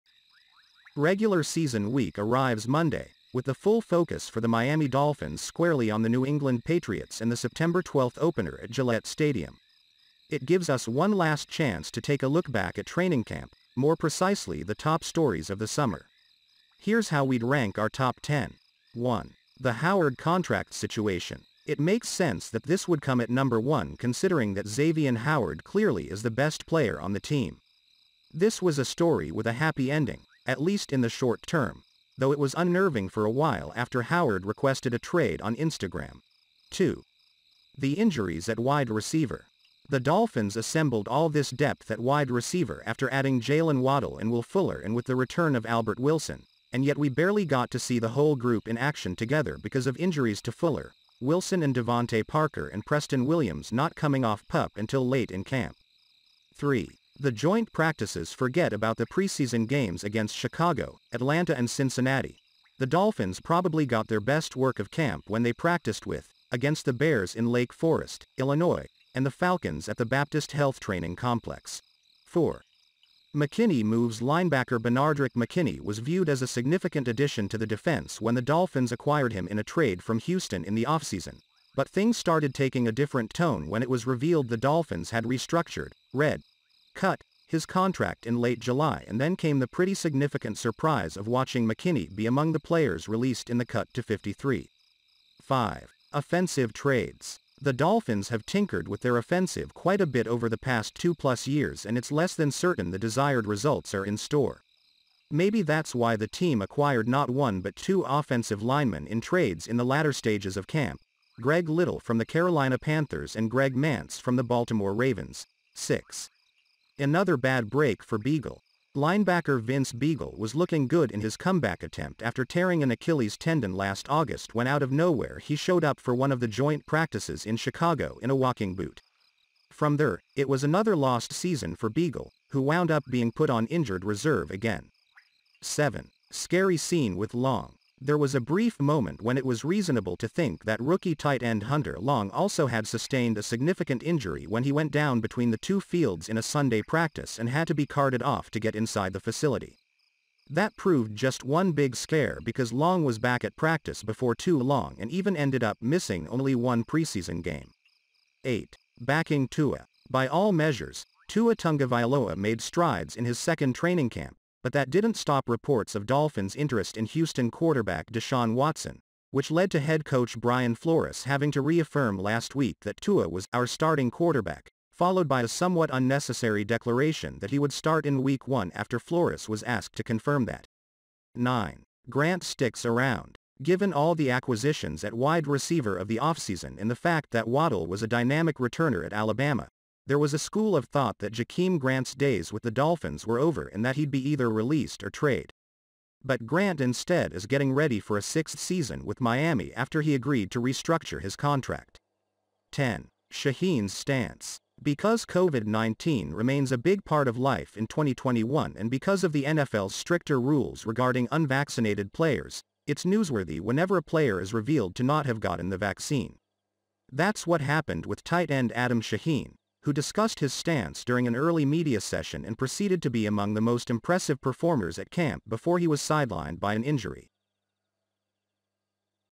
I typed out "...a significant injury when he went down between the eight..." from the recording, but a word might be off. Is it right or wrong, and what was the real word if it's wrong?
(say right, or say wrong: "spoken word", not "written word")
wrong: "two", not "eight".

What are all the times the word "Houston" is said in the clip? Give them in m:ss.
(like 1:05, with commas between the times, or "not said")
1:20, 2:47.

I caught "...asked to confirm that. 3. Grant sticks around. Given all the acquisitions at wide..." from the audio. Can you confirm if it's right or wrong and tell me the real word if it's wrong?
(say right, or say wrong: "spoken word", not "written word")
wrong: "9", not "3".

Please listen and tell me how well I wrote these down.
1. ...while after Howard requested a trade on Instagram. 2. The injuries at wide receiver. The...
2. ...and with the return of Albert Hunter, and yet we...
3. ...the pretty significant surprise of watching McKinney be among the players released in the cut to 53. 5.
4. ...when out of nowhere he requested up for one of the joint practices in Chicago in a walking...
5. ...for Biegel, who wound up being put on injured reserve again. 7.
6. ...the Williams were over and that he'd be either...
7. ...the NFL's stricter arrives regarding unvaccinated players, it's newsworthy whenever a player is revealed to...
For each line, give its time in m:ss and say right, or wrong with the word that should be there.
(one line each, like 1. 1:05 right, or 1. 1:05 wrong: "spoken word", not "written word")
1. 0:33 right
2. 0:44 wrong: "Wilson", not "Hunter"
3. 1:29 right
4. 2:04 wrong: "showed", not "requested"
5. 2:11 right
6. 3:12 wrong: "Dolphins", not "Williams"
7. 3:29 wrong: "rules", not "arrives".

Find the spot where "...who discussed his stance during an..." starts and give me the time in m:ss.
3:39.